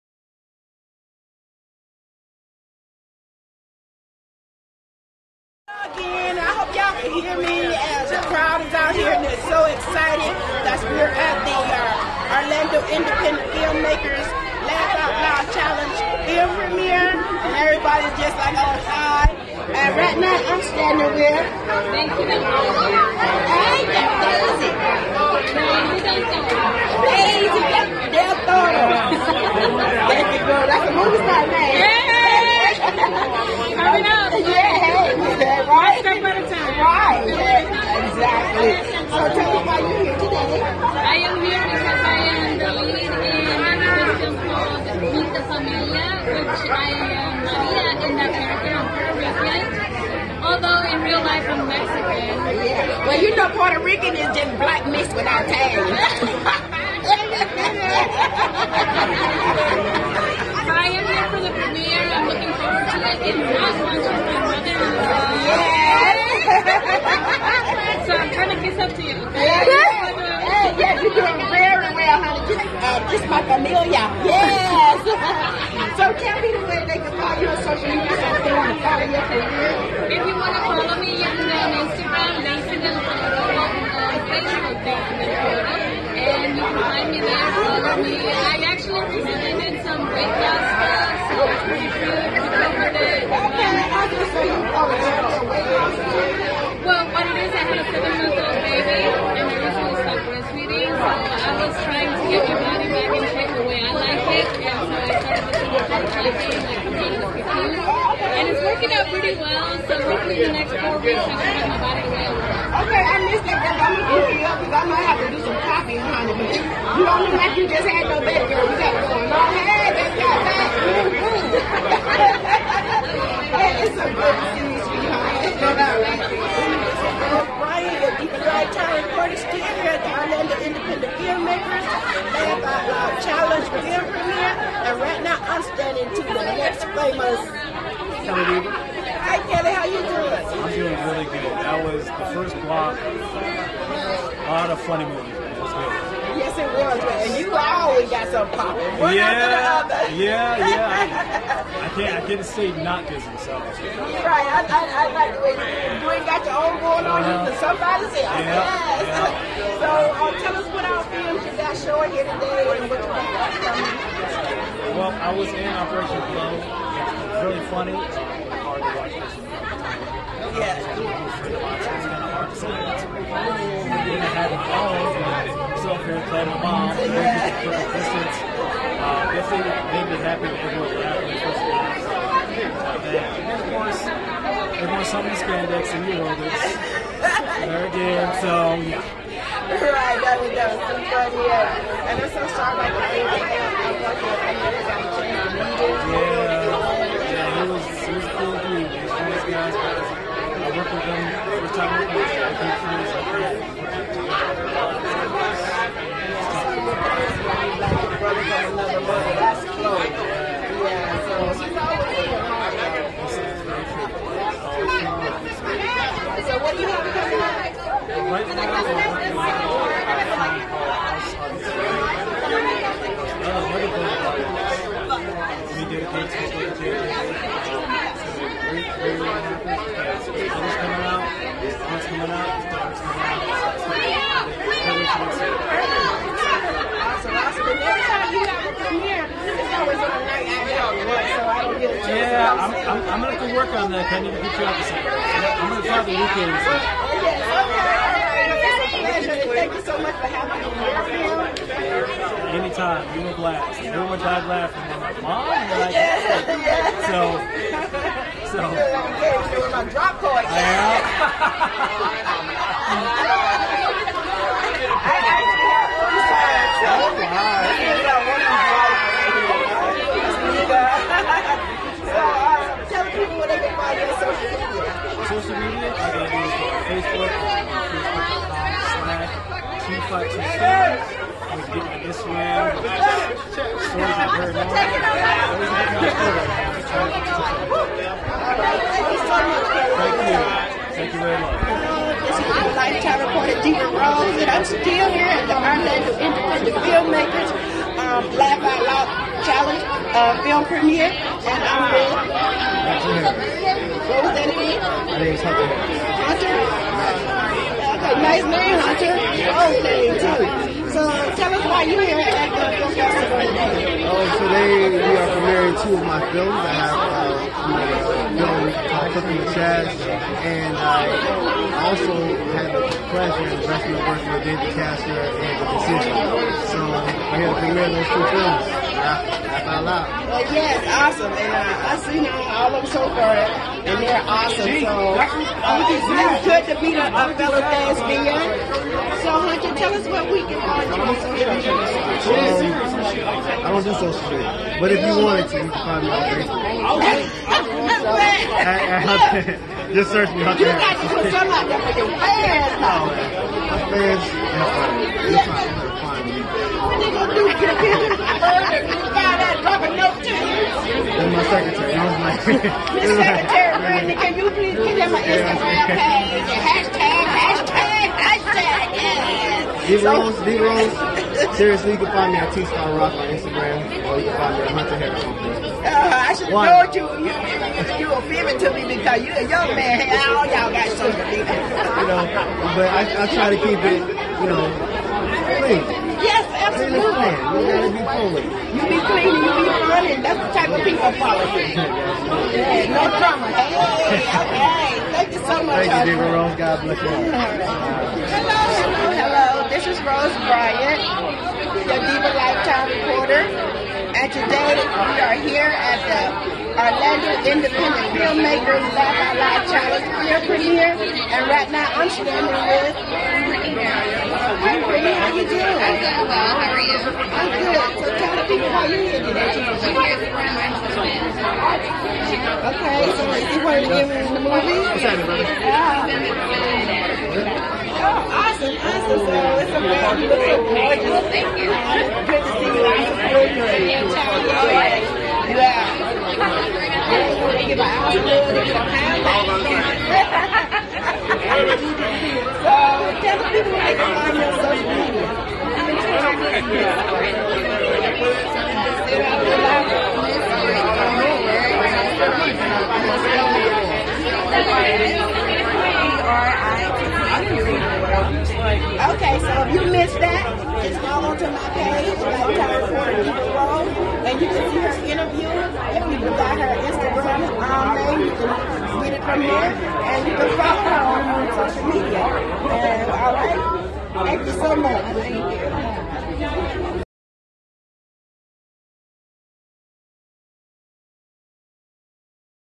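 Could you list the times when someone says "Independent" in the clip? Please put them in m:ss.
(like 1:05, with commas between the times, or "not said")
0:12, 4:55, 6:47.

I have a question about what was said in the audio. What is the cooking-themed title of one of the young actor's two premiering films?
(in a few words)
Cooking with Chaz.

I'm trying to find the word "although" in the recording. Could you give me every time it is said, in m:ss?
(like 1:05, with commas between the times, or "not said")
0:50.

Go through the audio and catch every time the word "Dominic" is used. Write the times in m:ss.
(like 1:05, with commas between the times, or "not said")
5:56.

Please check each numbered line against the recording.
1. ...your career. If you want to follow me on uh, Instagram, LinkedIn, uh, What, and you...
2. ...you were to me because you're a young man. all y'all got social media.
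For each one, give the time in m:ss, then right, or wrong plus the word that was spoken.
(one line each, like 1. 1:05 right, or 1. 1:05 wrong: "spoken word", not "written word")
1. 1:19 wrong: "Facebook", not "What"
2. 6:17 right.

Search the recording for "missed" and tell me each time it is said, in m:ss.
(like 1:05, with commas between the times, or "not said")
1:53, 7:39.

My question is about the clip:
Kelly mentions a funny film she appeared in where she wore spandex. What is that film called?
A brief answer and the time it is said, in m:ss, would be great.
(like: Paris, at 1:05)
Operation Flow, at 2:45.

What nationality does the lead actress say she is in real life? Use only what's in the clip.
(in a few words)
Mexican.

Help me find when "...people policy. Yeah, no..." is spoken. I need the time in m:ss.
6:30.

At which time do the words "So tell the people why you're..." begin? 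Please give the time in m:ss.
6:58.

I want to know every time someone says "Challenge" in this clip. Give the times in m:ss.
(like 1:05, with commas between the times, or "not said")
0:15, 4:59, 6:49.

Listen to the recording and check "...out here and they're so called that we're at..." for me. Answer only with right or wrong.
wrong.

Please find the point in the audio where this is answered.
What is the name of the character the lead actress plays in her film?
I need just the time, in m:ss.
0:47.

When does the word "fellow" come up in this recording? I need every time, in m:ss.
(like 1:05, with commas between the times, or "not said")
5:37.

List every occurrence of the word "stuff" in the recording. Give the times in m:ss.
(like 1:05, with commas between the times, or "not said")
1:30.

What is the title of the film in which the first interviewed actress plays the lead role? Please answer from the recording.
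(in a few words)
Meet the Familia.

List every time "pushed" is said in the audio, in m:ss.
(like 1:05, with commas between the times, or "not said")
not said.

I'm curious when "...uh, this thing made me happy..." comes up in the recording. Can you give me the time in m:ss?
2:58.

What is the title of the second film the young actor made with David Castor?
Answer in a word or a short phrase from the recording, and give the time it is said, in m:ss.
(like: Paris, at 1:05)
The Decision, at 5:25.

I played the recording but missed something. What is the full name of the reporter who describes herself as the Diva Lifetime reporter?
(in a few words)
Rose Bryant.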